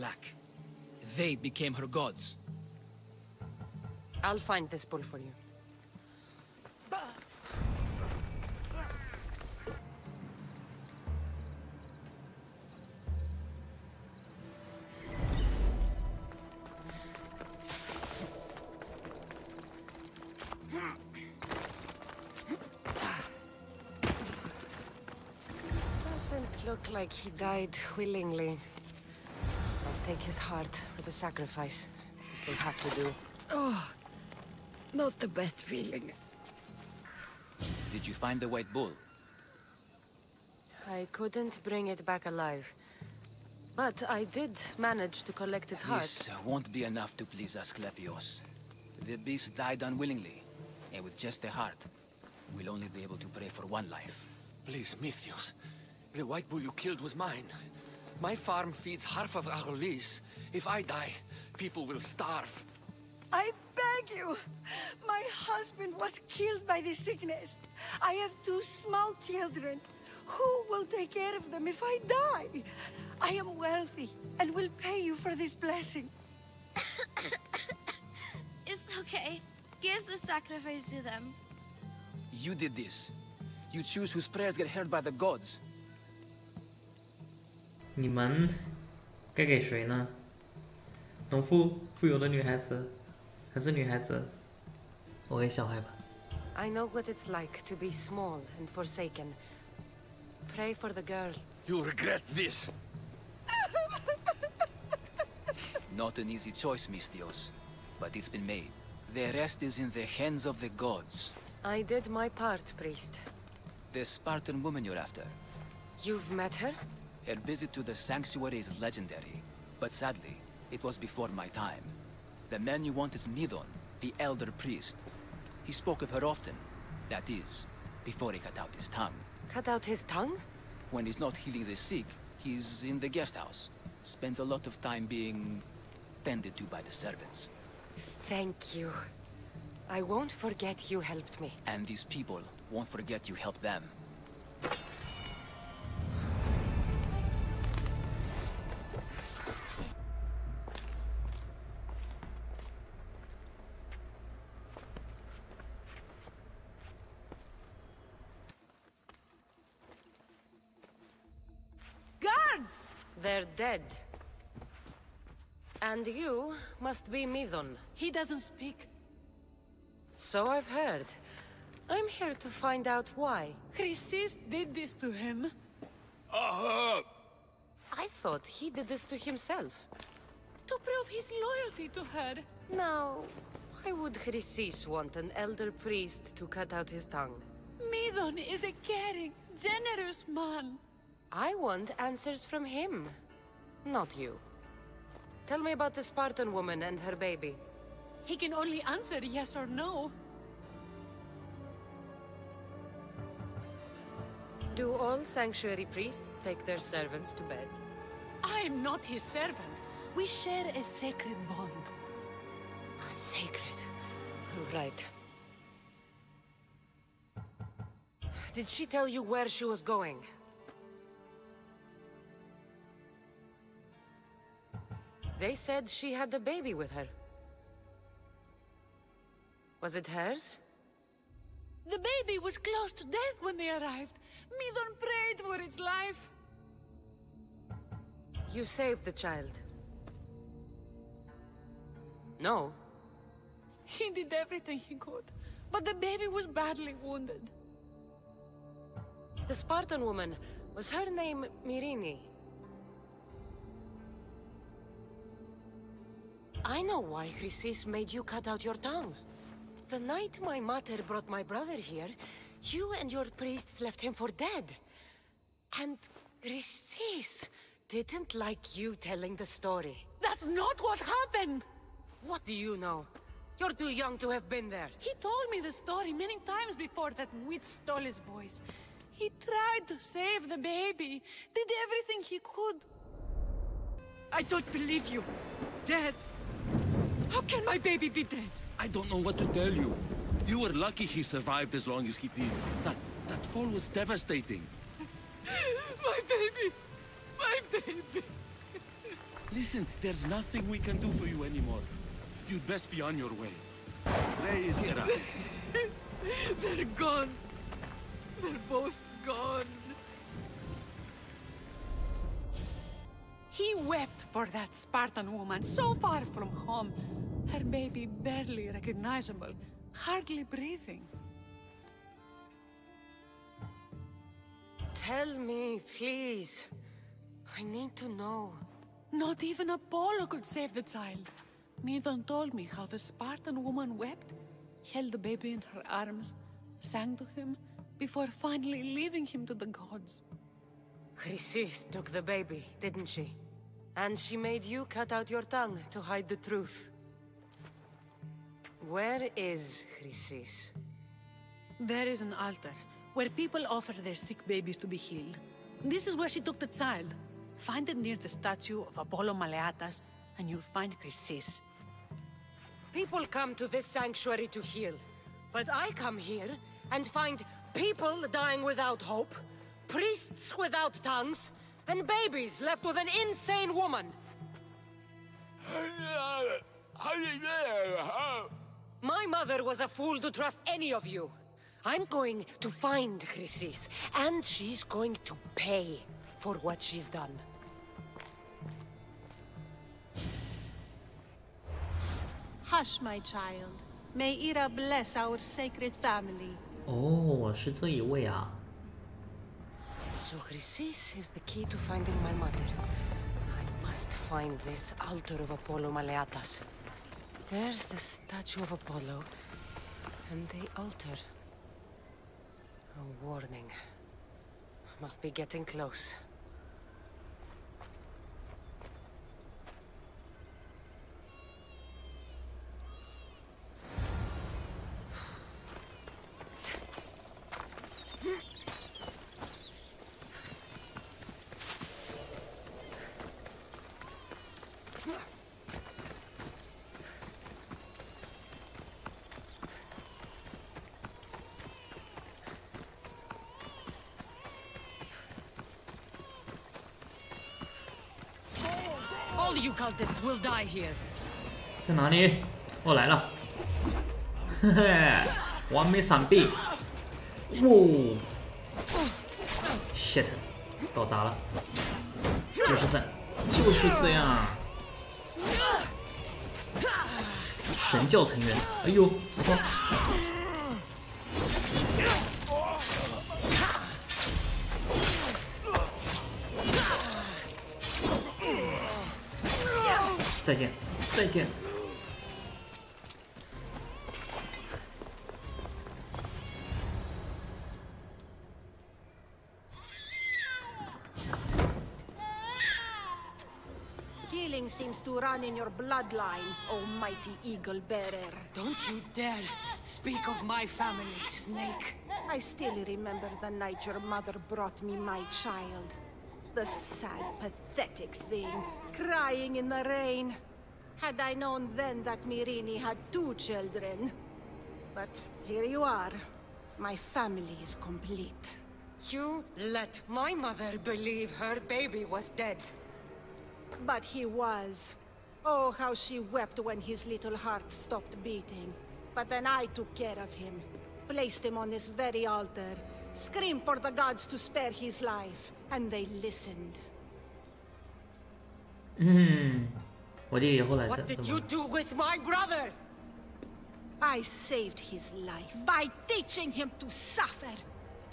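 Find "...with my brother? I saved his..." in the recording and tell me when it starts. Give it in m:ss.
9:01.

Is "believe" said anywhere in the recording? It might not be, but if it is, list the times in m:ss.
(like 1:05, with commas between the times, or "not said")
4:44, 8:40.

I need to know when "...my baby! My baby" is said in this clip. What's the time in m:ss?
4:54.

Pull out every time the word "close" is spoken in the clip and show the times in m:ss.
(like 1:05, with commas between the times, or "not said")
3:52, 6:55.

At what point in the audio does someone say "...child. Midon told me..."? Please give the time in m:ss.
5:30.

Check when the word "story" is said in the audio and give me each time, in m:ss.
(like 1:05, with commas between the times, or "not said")
4:29, 4:35.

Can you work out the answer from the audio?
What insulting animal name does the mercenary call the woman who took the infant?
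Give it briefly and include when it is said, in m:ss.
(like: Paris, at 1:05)
Snake, at 8:21.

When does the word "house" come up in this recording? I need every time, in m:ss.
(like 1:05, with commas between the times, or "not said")
2:13.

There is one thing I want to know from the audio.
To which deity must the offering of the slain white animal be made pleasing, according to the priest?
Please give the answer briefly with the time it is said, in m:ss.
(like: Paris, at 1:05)
Asclepios, at 0:47.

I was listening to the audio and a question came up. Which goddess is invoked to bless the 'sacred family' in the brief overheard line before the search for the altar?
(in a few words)
Ira.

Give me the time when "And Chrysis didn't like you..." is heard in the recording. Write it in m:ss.
4:25.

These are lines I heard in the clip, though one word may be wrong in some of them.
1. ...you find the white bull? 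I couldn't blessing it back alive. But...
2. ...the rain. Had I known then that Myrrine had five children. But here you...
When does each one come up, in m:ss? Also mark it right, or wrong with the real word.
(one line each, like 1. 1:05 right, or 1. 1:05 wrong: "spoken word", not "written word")
1. 0:38 wrong: "bring", not "blessing"
2. 8:29 wrong: "two", not "five".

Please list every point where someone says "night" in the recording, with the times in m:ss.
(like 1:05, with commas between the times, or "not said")
4:19, 8:23.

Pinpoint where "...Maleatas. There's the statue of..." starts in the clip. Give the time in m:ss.
6:45.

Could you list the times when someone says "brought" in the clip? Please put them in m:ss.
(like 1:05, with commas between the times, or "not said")
4:21, 8:24.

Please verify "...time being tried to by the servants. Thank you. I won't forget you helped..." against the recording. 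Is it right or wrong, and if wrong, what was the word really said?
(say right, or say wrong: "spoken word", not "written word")
wrong: "tended", not "tried".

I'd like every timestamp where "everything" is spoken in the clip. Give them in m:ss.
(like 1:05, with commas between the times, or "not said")
4:04, 4:41.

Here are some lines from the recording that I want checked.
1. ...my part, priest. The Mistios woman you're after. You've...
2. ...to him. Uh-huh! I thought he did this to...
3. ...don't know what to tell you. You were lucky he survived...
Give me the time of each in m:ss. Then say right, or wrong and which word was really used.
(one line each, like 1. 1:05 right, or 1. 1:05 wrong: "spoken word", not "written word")
1. 1:52 wrong: "Spartan", not "Mistios"
2. 2:54 right
3. 4:48 right.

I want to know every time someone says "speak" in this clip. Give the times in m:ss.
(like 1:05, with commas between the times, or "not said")
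2:48, 8:19.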